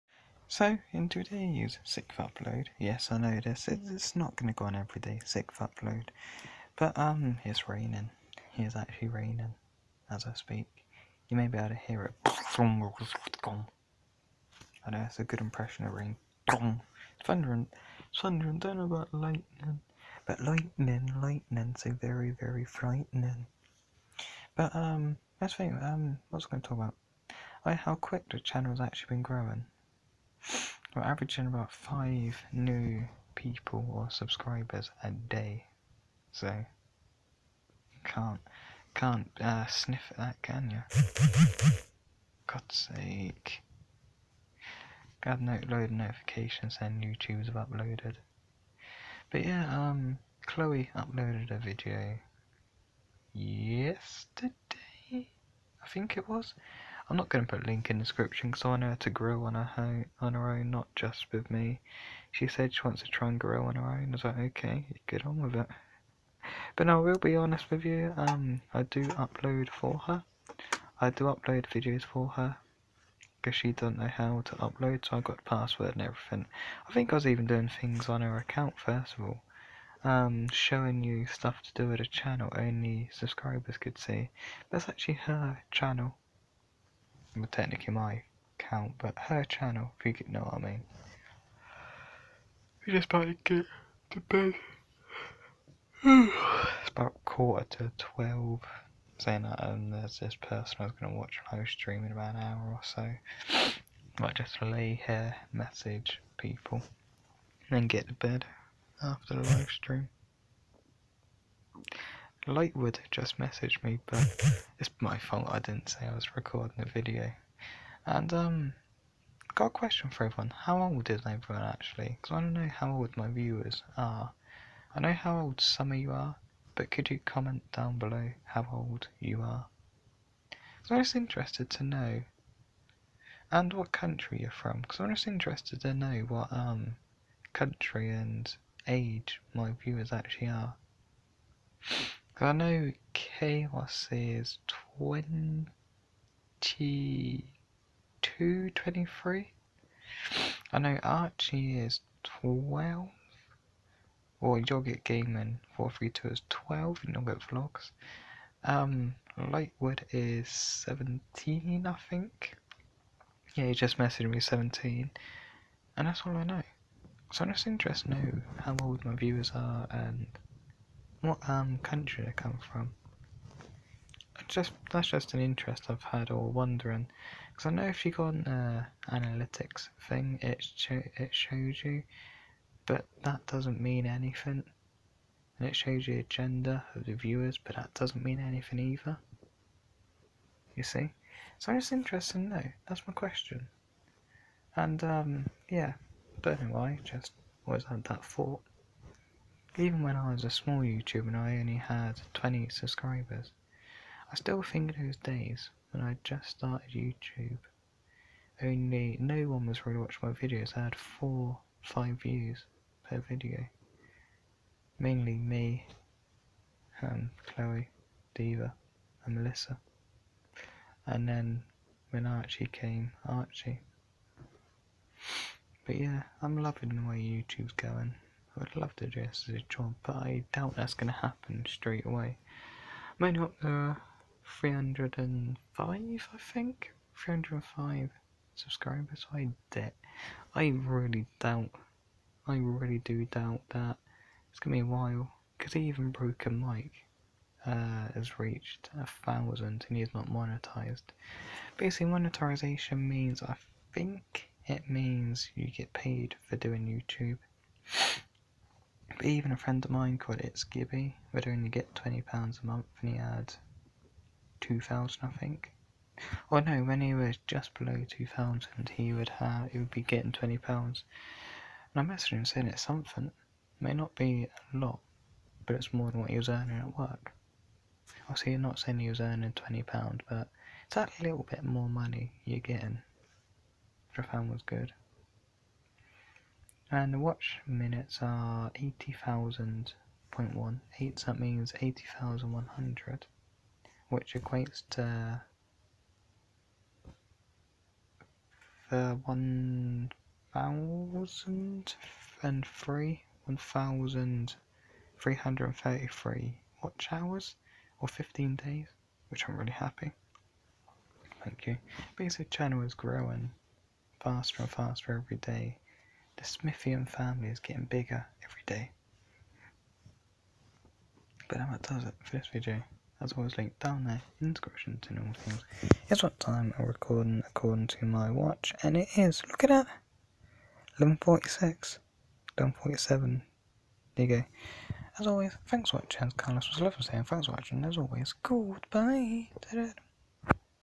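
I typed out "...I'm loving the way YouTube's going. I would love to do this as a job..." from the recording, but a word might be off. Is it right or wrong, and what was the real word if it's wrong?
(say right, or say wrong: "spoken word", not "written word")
right.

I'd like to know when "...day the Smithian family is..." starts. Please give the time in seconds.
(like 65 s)
315 s.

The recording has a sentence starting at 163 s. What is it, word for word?
Yeah, he just messaged me 17.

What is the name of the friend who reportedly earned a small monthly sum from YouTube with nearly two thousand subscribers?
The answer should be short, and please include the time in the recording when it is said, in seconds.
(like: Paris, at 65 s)
Gibby, at 260 s.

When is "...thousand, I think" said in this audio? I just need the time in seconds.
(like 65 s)
264 s.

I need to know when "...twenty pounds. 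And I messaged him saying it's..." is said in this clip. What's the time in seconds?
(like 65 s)
270 s.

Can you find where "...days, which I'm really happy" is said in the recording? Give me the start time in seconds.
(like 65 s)
308 s.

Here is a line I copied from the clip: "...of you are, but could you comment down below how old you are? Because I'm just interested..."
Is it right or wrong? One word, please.
right.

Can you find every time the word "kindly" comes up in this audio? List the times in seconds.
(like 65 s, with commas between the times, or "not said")
not said.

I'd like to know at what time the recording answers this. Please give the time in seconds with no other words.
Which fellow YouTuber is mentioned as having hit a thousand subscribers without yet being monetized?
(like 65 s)
246 s.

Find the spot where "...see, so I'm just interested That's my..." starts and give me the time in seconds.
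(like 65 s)
190 s.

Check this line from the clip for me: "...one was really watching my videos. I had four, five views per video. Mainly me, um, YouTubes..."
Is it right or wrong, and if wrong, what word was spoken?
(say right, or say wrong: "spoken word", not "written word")
wrong: "Chloe", not "YouTubes".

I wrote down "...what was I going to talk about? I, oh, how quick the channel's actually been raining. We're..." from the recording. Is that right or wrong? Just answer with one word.
wrong.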